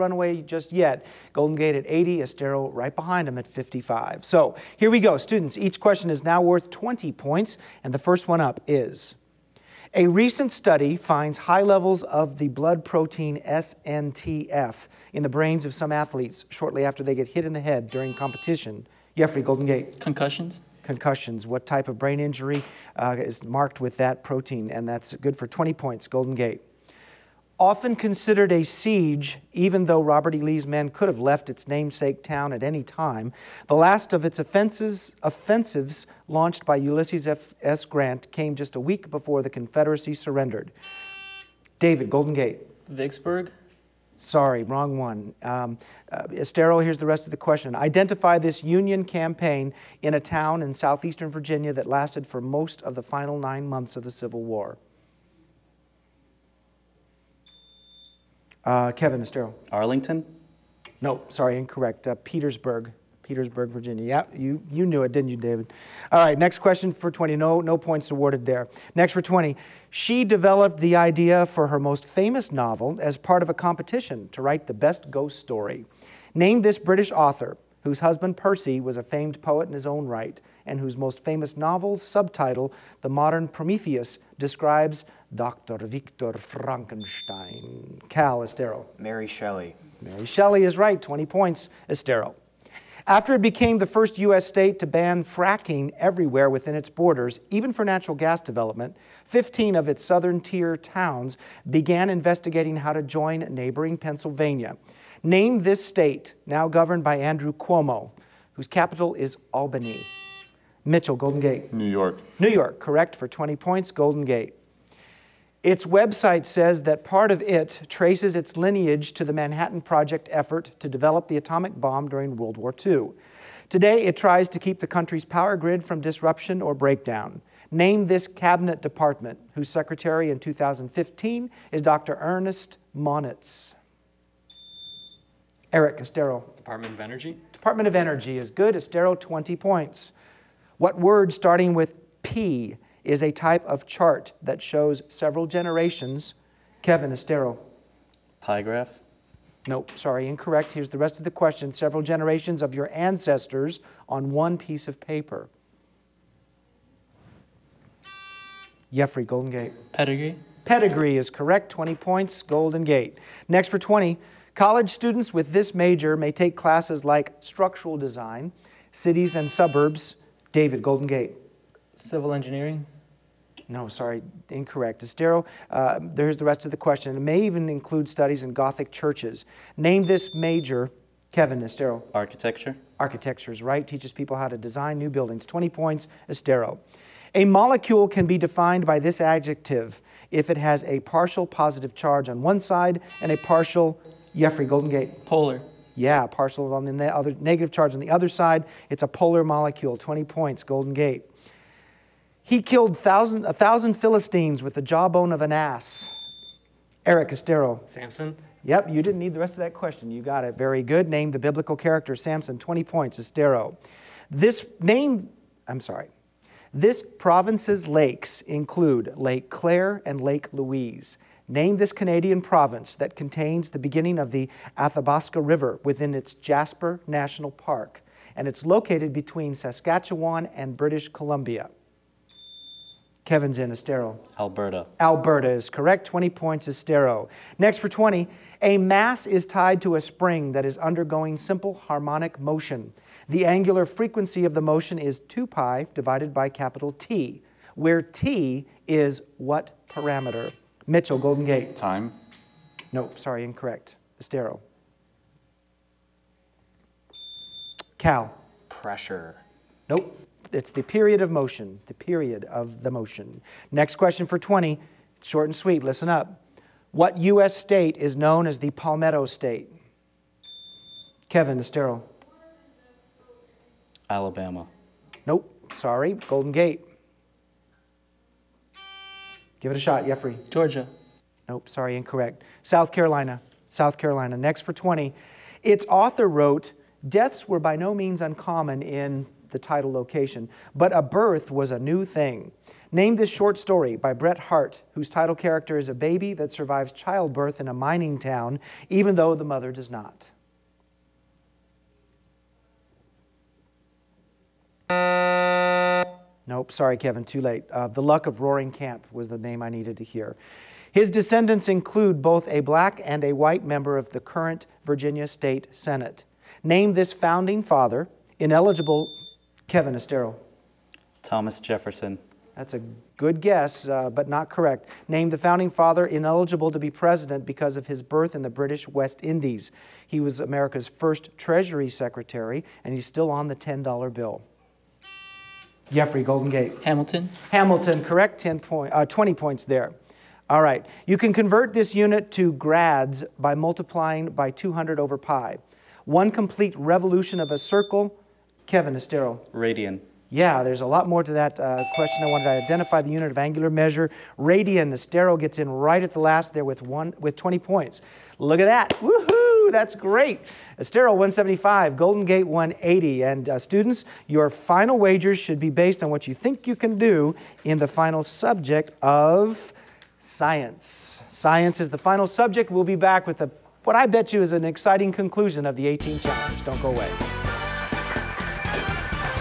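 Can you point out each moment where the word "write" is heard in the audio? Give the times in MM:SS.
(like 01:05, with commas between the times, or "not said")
01:14.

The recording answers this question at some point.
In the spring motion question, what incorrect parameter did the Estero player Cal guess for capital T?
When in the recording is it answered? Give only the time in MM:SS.
04:18.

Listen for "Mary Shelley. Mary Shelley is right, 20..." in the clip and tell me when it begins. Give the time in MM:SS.
01:28.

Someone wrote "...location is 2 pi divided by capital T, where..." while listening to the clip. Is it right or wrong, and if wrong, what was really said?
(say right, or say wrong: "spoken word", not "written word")
wrong: "motion", not "location".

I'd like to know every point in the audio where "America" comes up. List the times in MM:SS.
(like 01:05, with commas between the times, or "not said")
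05:30.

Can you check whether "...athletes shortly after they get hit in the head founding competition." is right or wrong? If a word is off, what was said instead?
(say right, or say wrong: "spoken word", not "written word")
wrong: "during", not "founding".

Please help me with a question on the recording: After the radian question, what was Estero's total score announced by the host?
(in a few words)
175.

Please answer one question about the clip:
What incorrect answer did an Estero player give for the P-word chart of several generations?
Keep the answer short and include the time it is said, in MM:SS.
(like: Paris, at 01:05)
Pie graph, at 02:28.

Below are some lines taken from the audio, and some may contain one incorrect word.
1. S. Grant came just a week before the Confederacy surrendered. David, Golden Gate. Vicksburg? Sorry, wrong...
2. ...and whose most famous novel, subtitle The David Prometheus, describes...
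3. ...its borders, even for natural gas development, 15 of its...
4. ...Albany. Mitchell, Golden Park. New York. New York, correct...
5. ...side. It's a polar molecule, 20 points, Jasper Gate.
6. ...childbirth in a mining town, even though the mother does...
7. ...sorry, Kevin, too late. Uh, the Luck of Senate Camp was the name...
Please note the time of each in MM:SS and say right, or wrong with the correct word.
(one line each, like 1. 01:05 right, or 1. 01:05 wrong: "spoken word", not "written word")
1. 00:37 right
2. 01:20 wrong: "Modern", not "David"
3. 01:36 right
4. 01:49 wrong: "Gate", not "Park"
5. 03:18 wrong: "Golden", not "Jasper"
6. 04:56 right
7. 05:06 wrong: "Roaring", not "Senate".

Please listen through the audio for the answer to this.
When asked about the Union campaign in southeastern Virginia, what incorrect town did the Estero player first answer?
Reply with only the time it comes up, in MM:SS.
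00:59.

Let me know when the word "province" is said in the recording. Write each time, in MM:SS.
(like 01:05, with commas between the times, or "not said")
03:37, 03:42.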